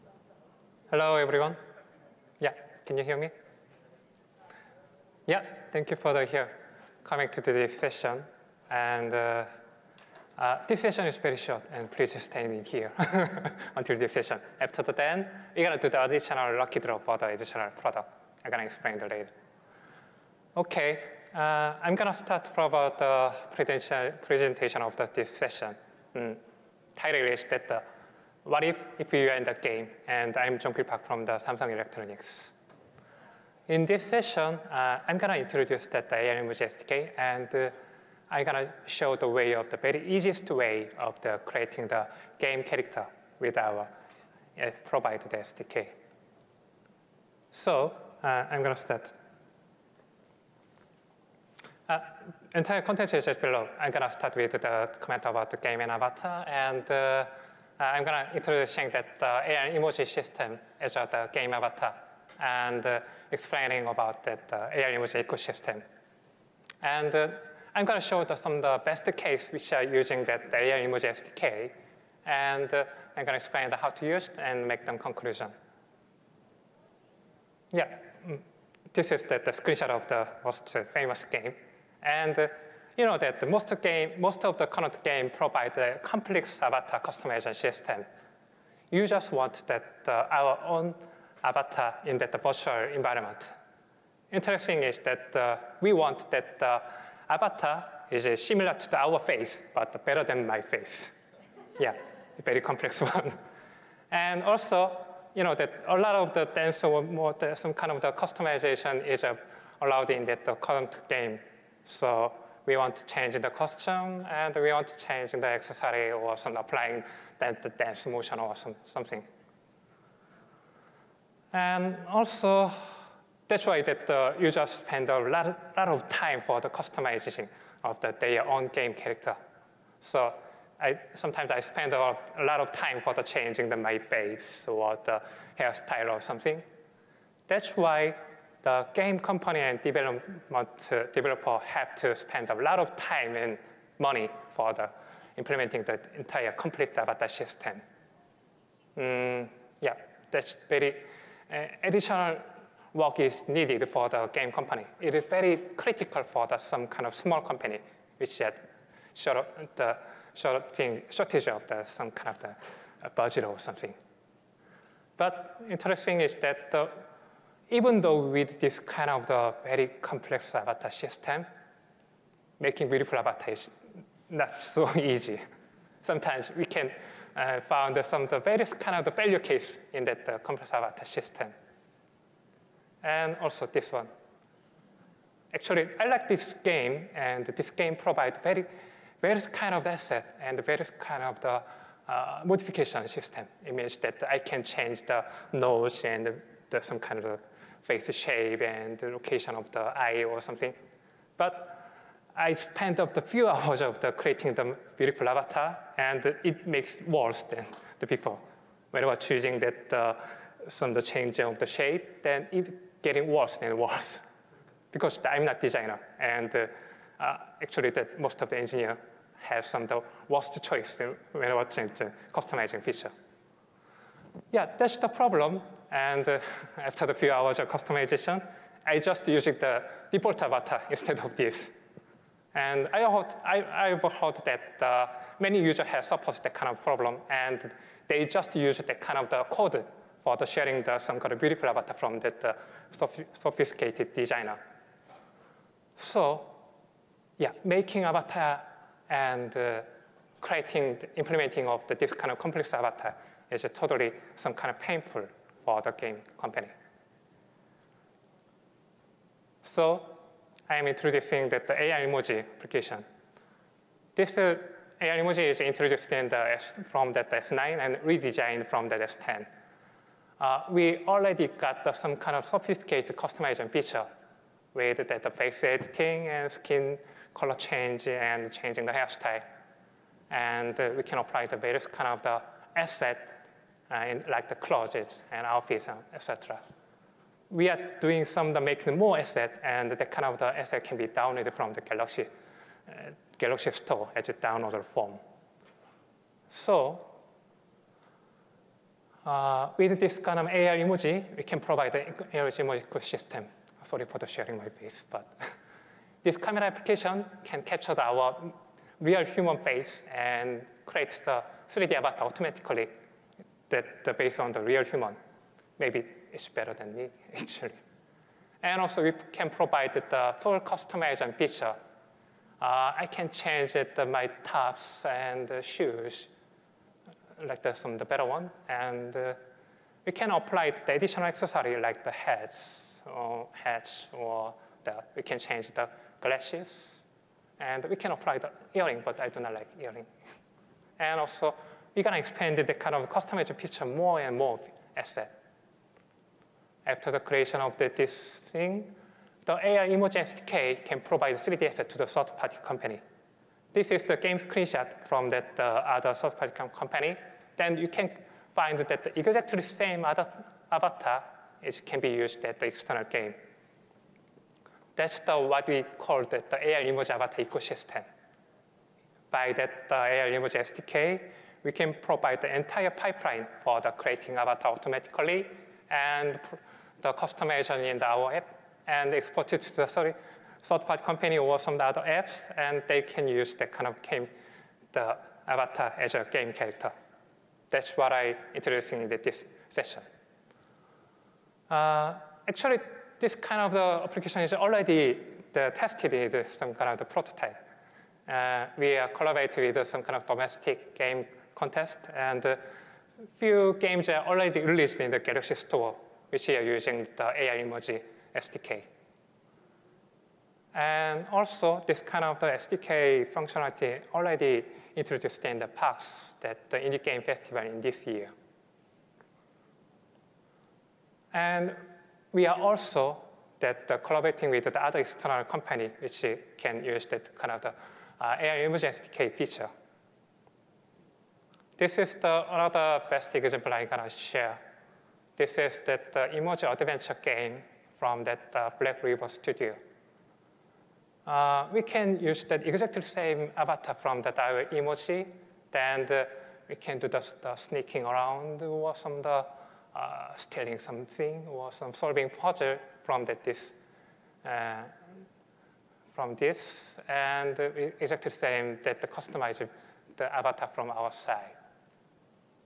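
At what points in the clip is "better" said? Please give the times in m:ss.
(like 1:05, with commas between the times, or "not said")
1:40, 5:16, 5:28.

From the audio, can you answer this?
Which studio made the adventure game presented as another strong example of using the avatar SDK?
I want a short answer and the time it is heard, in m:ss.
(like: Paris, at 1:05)
Black River Studio, at 7:18.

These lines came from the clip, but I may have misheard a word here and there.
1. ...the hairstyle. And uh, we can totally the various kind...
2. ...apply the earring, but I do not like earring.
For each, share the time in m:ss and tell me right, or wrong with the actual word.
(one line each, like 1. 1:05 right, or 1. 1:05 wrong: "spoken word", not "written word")
1. 4:38 wrong: "apply", not "totally"
2. 5:38 right.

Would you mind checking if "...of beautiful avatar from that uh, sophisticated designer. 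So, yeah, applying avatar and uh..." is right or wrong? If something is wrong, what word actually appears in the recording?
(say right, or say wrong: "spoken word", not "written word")
wrong: "making", not "applying".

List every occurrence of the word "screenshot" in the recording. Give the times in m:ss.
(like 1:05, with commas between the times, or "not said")
1:19, 5:54.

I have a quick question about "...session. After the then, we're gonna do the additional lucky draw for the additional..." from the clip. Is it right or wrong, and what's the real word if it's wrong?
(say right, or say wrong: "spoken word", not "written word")
right.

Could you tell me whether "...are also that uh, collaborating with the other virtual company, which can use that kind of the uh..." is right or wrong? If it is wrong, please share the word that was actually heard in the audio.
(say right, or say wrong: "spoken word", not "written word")
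wrong: "external", not "virtual".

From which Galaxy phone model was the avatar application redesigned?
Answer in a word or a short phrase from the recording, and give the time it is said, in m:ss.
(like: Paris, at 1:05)
S10, at 4:28.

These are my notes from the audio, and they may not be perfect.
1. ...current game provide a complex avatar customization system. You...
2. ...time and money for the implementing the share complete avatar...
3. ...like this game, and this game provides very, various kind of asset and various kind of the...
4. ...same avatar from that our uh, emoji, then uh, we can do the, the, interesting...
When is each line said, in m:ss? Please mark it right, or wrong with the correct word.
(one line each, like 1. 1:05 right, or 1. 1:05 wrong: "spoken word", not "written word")
1. 1:24 right
2. 2:22 wrong: "entire", not "share"
3. 3:06 right
4. 7:23 wrong: "sneaking", not "interesting".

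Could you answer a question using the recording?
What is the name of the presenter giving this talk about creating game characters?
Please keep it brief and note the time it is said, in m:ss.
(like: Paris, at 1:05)
Jong-Pil Park, at 0:30.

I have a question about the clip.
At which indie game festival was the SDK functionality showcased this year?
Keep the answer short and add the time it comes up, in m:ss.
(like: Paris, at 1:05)
PAX, at 6:55.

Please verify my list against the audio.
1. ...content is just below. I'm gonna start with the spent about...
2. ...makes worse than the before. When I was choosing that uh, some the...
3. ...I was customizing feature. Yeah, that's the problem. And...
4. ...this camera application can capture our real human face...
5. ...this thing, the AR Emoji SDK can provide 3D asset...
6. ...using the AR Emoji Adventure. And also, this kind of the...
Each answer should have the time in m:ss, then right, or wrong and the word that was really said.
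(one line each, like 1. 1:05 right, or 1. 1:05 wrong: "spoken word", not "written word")
1. 0:52 wrong: "comment", not "spent"
2. 3:26 right
3. 3:41 right
4. 5:06 right
5. 5:47 right
6. 6:46 wrong: "SDK", not "Adventure".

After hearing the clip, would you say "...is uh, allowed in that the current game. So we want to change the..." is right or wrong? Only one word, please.
right.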